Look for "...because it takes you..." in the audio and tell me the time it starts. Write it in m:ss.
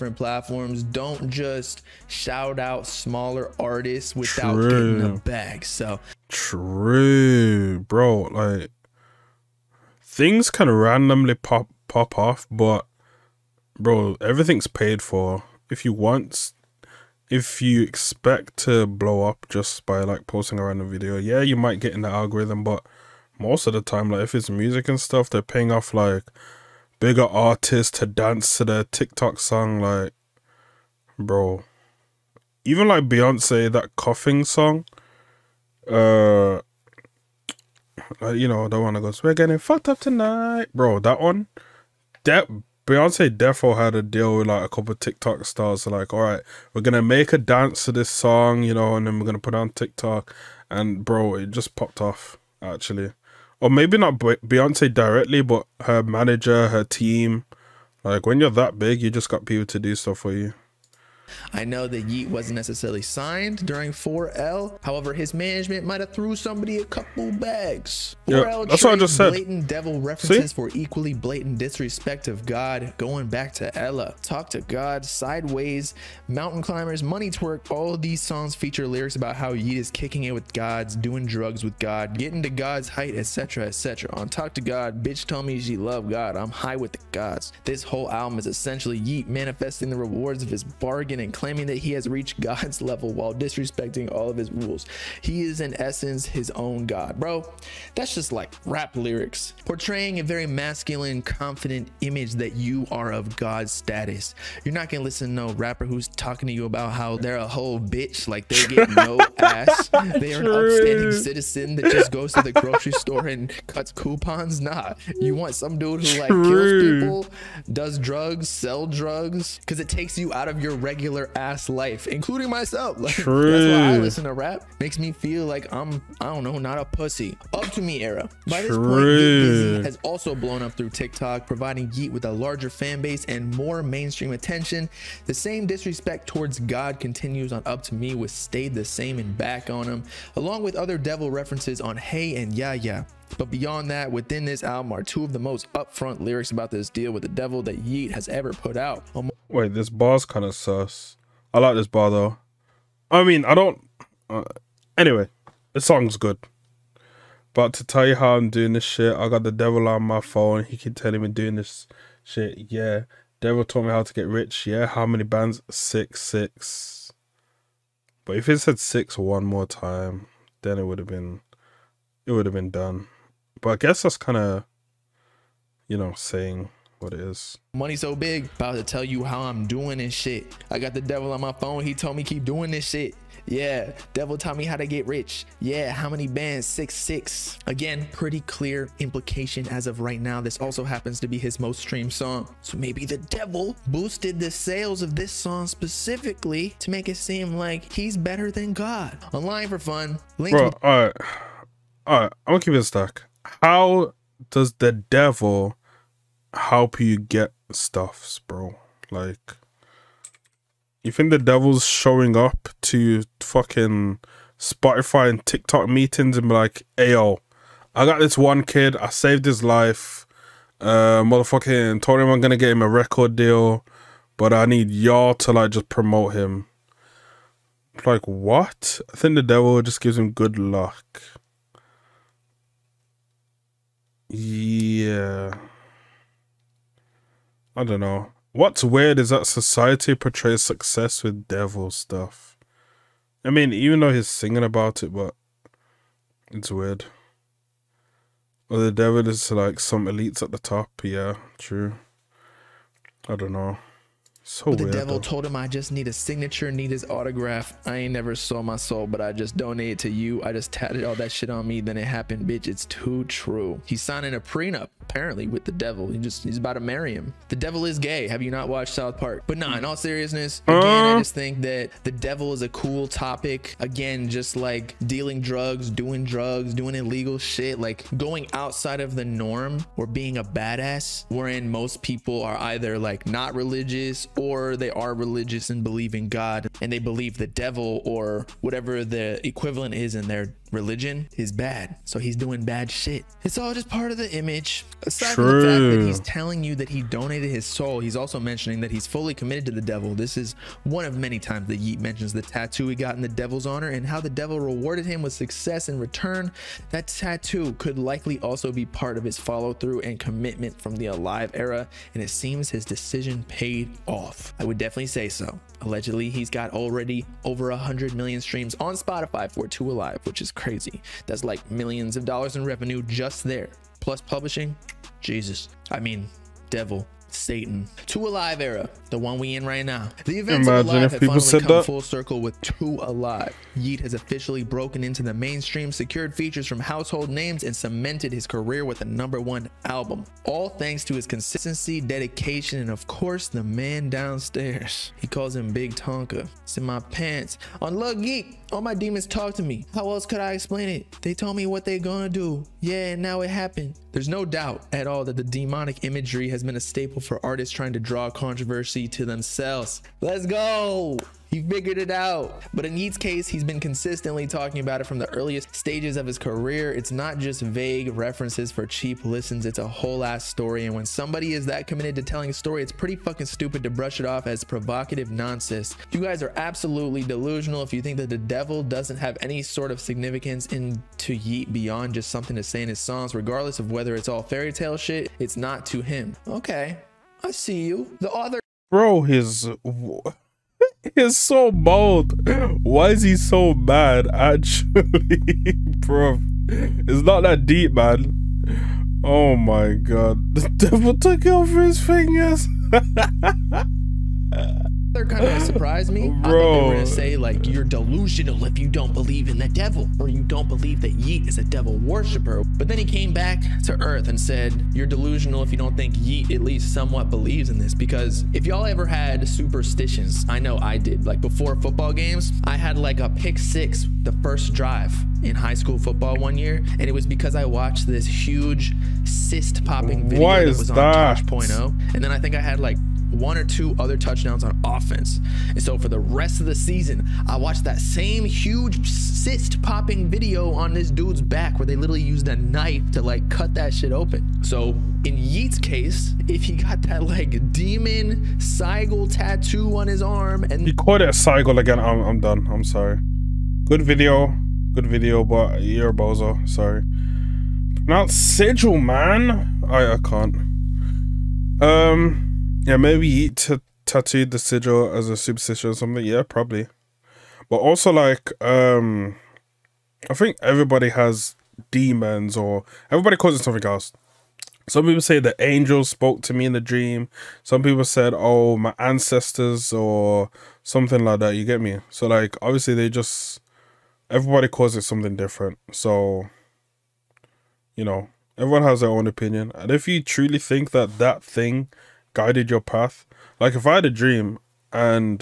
1:59.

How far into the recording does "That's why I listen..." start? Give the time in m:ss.
2:03.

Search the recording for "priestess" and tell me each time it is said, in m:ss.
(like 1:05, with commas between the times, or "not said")
not said.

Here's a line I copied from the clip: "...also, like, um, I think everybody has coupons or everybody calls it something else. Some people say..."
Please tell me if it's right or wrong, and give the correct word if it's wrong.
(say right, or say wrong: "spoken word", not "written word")
wrong: "demons", not "coupons".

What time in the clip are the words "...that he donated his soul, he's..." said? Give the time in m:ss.
4:56.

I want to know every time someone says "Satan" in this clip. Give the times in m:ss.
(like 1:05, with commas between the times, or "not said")
5:27.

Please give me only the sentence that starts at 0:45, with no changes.
like, all right, we're gonna make a dance to this song, you know, and then we're gonna put on TikTok.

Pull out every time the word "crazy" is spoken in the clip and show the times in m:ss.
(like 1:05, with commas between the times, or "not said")
5:20.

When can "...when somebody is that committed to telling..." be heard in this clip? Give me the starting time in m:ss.
6:10.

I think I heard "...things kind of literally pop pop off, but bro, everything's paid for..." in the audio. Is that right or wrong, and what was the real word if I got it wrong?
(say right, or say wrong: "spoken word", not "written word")
wrong: "randomly", not "literally".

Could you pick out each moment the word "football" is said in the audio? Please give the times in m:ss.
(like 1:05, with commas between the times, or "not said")
7:01, 7:05.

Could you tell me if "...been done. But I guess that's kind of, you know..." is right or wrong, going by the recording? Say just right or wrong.
right.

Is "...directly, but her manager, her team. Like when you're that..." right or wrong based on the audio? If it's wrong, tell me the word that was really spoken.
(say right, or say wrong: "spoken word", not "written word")
right.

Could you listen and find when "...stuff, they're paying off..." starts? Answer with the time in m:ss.
0:24.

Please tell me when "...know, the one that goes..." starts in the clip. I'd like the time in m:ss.
0:38.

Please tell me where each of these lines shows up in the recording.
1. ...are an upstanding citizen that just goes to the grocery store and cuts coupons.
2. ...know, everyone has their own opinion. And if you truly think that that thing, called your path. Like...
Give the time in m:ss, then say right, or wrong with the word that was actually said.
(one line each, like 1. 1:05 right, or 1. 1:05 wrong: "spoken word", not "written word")
1. 1:50 right
2. 8:08 wrong: "guided", not "called".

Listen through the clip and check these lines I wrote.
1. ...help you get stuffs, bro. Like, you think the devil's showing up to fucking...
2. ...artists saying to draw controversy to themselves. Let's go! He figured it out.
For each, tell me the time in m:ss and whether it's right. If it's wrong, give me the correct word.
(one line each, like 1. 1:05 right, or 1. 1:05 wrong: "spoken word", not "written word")
1. 3:26 right
2. 5:57 wrong: "trying", not "saying".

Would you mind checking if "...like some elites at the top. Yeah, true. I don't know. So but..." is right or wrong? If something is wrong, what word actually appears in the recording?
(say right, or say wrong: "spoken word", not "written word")
right.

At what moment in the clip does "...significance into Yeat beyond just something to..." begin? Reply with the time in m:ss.
6:19.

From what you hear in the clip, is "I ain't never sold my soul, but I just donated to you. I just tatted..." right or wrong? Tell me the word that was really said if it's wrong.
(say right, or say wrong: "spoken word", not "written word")
right.